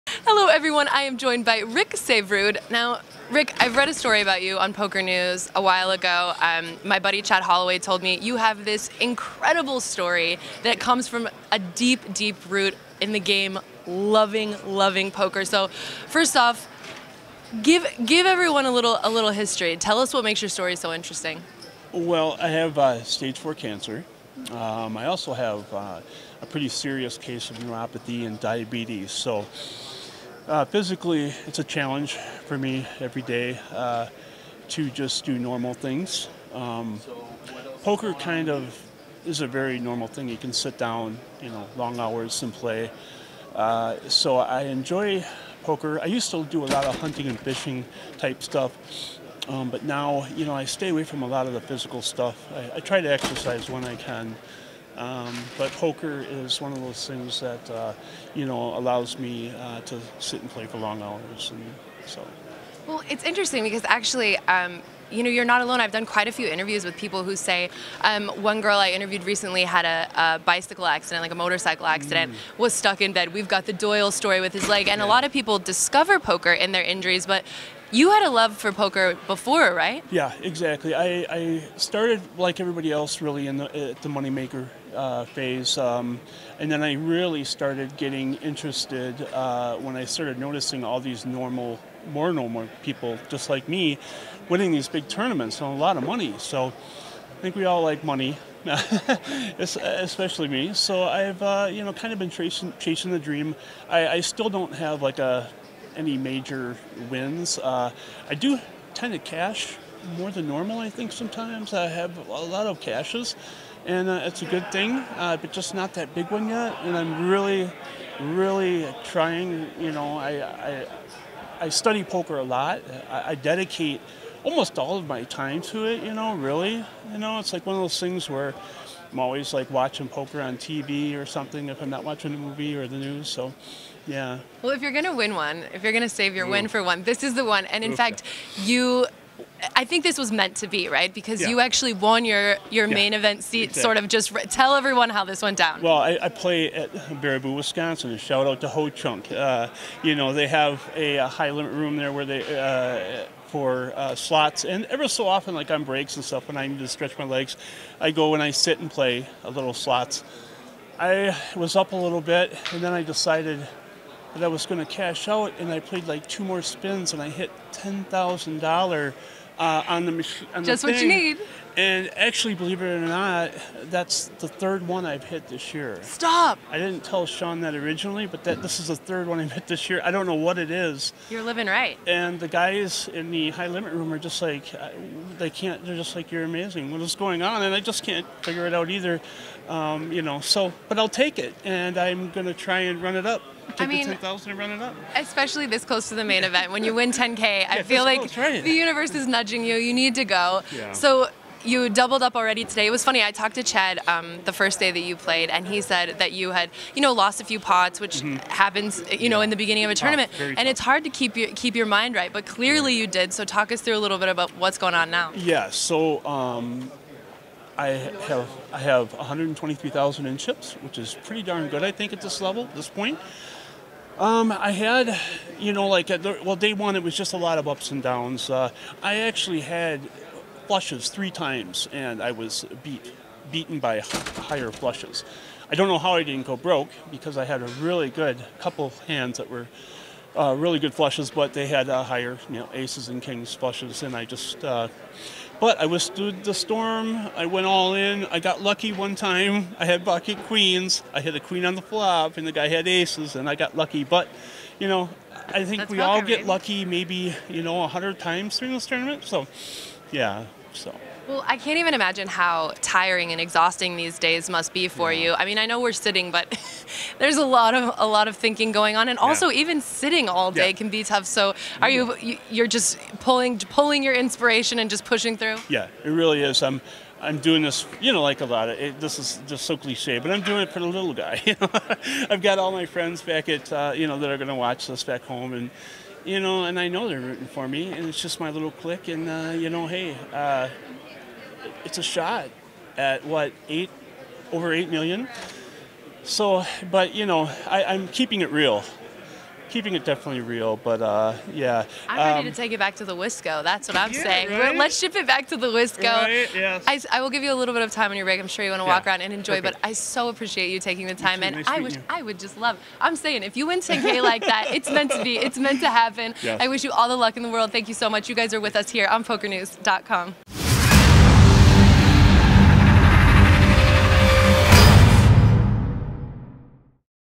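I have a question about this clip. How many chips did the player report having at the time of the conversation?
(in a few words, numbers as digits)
123,000.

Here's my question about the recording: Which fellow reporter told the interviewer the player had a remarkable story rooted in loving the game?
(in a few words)
Chad Holloway.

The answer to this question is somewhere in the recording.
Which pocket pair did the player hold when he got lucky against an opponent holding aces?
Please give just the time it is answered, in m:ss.
4:10.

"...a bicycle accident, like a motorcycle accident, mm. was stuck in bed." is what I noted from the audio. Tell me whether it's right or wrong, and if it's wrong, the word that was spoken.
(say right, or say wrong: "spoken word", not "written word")
right.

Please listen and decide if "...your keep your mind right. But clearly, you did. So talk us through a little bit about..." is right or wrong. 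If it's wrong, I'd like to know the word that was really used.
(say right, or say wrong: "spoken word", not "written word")
right.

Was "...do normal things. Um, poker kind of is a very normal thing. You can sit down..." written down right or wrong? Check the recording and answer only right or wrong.
right.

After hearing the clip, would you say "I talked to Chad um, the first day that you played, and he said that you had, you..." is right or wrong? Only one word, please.
right.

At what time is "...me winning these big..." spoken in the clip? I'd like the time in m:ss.
1:33.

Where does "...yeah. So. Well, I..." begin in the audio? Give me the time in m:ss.
4:20.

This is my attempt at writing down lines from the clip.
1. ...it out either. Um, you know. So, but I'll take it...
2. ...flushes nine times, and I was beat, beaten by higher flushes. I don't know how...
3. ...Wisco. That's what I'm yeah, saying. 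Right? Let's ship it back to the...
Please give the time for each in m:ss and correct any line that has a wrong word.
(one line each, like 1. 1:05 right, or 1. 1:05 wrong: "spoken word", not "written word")
1. 3:08 right
2. 3:50 wrong: "three", not "nine"
3. 5:03 right.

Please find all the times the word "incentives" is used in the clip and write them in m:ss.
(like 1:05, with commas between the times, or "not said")
not said.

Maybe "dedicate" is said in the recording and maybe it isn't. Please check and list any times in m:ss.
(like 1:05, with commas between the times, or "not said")
2:03.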